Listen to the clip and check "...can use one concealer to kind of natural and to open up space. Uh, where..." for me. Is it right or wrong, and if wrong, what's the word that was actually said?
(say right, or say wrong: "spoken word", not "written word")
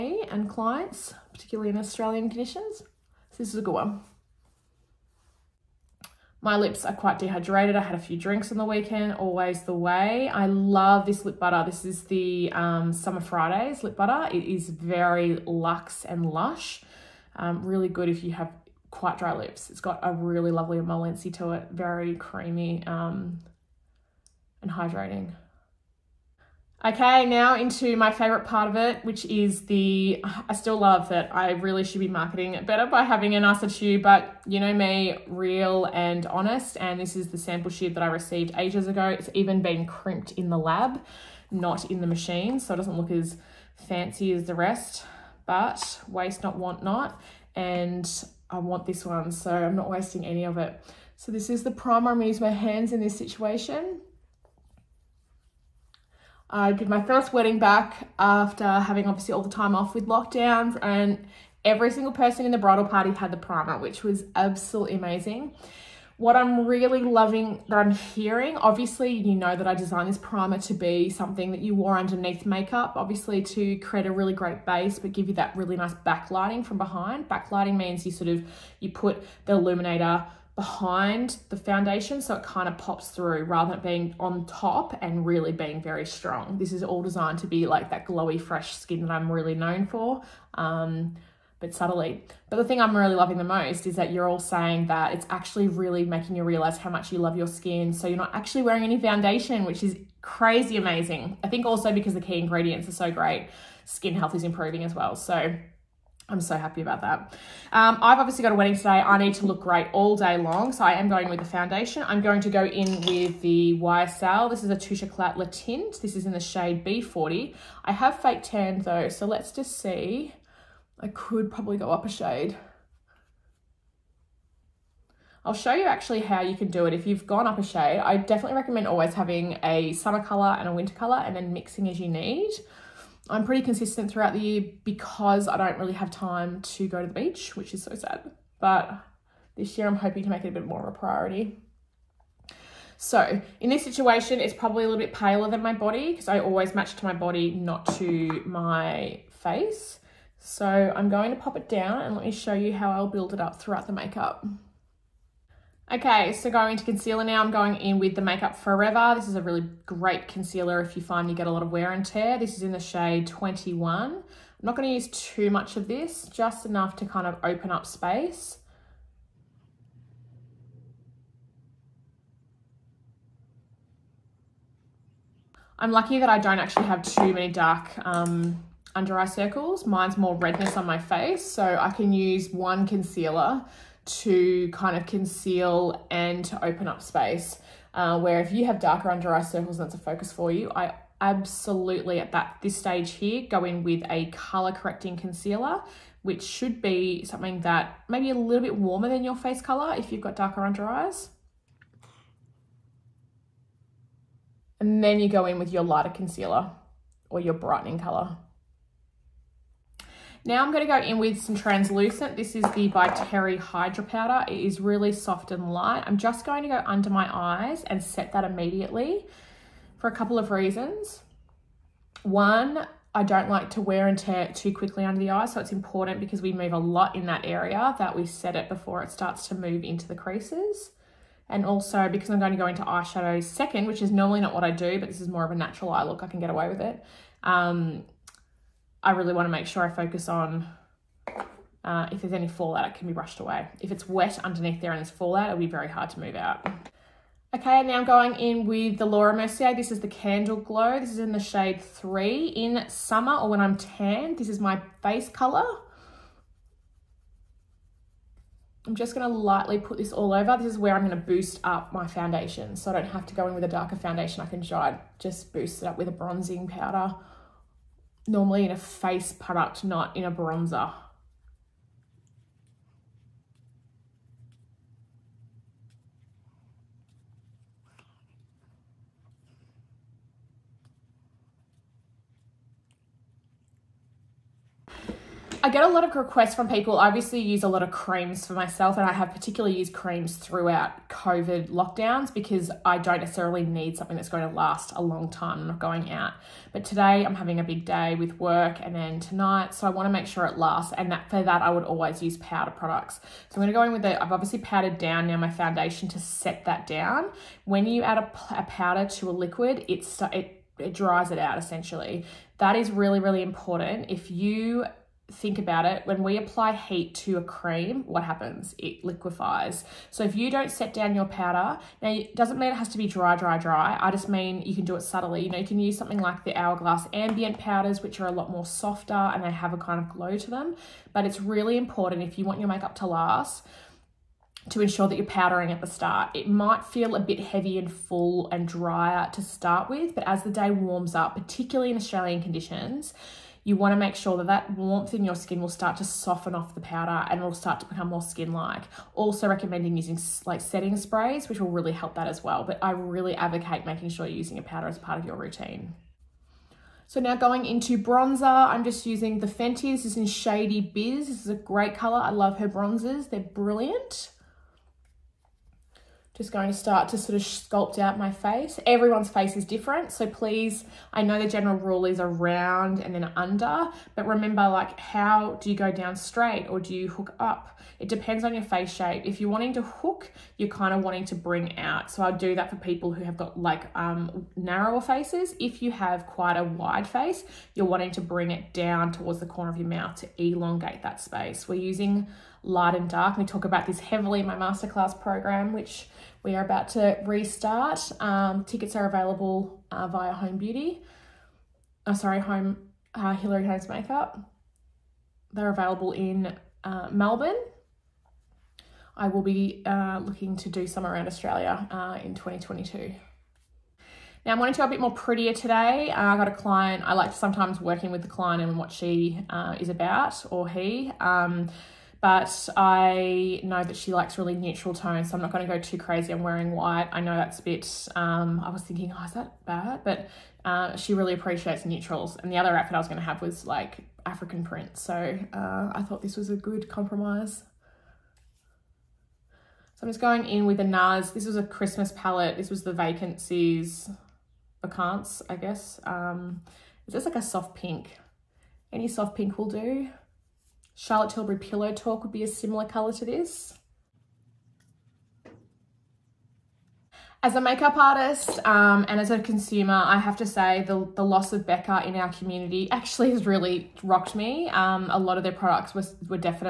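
wrong: "conceal", not "natural".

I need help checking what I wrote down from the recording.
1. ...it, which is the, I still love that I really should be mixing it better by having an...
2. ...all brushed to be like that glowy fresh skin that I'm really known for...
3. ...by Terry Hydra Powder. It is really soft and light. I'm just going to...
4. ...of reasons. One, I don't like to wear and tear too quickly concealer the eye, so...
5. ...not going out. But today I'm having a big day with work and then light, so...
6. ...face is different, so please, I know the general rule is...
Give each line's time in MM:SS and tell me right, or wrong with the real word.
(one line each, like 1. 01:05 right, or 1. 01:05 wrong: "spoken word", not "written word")
1. 00:28 wrong: "marketing", not "mixing"
2. 01:26 wrong: "designed", not "brushed"
3. 03:32 right
4. 03:40 wrong: "under", not "concealer"
5. 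04:55 wrong: "tonight", not "light"
6. 06:09 right.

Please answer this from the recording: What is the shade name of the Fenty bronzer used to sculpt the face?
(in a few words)
Shady Biz.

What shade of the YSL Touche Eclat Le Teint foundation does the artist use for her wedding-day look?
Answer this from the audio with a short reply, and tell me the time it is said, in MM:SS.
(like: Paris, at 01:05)
B40, at 01:56.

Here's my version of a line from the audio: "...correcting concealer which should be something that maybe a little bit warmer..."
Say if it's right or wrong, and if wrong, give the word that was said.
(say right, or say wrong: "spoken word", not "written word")
right.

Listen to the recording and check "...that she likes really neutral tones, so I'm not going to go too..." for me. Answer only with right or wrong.
right.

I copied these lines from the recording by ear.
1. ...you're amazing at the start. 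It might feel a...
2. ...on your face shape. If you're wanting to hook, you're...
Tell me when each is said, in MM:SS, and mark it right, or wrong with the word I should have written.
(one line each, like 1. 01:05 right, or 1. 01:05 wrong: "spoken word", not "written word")
1. 05:35 wrong: "powdering", not "amazing"
2. 06:18 right.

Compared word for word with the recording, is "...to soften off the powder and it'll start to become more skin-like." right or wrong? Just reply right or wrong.
right.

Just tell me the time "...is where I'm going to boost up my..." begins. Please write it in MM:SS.
04:20.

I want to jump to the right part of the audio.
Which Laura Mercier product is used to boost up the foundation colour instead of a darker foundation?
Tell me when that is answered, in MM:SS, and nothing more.
04:10.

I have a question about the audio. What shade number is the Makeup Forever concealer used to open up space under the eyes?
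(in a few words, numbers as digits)
21.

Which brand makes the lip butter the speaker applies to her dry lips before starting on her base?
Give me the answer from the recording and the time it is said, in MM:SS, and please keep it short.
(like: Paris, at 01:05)
Summer Fridays, at 00:12.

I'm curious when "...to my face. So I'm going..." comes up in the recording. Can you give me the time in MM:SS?
02:27.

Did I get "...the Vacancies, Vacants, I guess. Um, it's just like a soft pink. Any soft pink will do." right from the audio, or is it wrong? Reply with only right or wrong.
right.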